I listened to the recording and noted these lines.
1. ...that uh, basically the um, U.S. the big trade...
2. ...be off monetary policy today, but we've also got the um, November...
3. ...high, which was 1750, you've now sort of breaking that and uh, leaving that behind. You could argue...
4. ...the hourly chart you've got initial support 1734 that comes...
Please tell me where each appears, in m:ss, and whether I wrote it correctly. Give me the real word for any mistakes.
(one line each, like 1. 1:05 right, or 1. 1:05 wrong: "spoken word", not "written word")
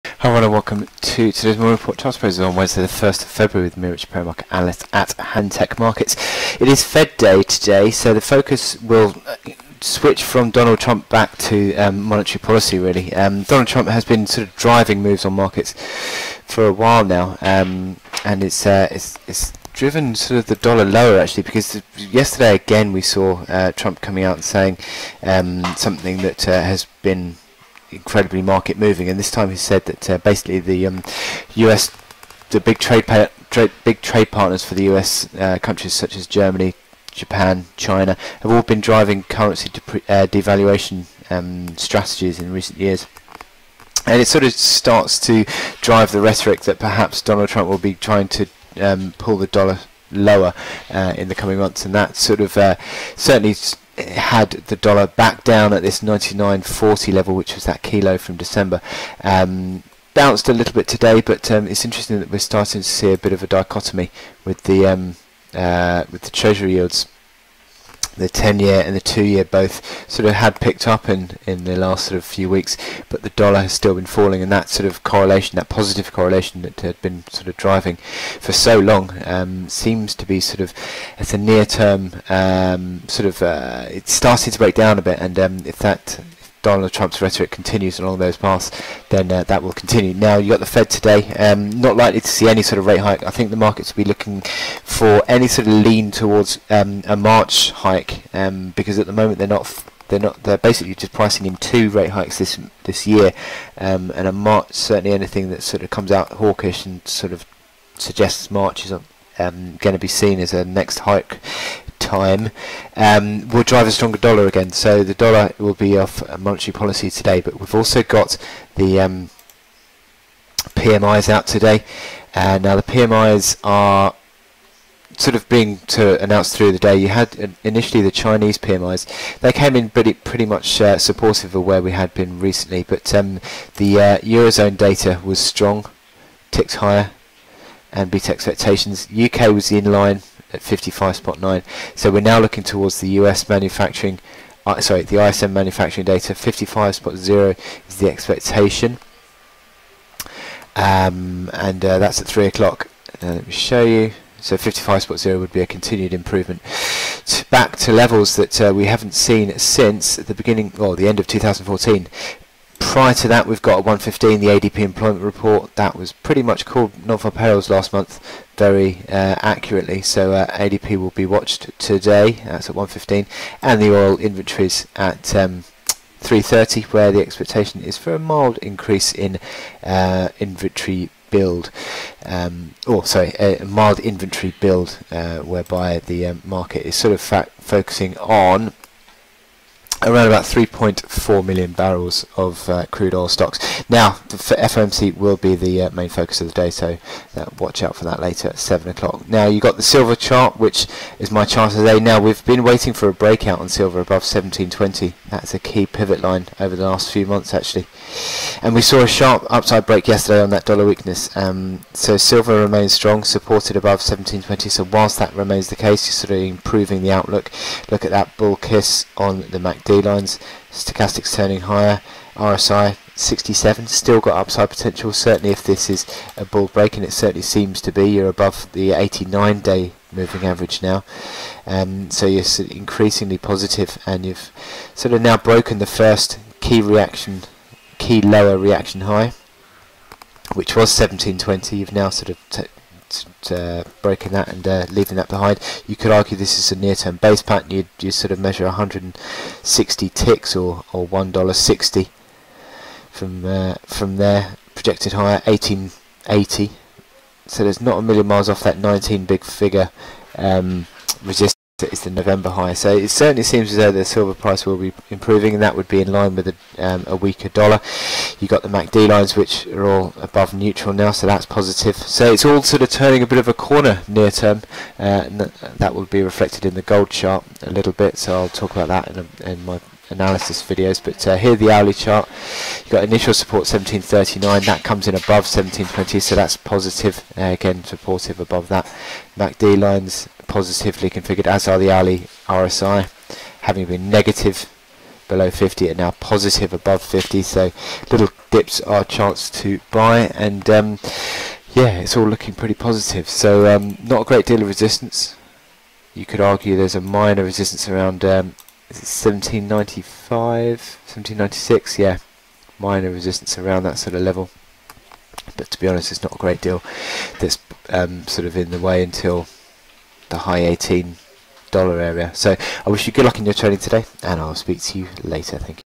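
1. 0:29 right
2. 1:55 wrong: "PMIs", not "November"
3. 3:59 wrong: "1720", not "1750"
4. 4:41 wrong: "1739", not "1734".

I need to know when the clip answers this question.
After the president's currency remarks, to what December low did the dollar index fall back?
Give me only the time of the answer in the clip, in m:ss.
0:56.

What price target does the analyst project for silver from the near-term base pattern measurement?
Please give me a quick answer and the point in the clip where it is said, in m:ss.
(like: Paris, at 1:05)
1880, at 4:15.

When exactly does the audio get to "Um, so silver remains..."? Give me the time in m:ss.
3:31.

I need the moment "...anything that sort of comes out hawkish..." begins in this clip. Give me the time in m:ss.
1:45.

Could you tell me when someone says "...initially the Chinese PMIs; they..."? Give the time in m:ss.
2:07.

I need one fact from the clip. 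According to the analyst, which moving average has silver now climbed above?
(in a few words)
89 day.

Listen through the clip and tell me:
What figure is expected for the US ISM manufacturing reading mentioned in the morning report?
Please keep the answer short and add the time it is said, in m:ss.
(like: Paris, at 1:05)
55.0, at 2:26.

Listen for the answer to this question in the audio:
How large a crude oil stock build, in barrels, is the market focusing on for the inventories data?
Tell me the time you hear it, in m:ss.
3:10.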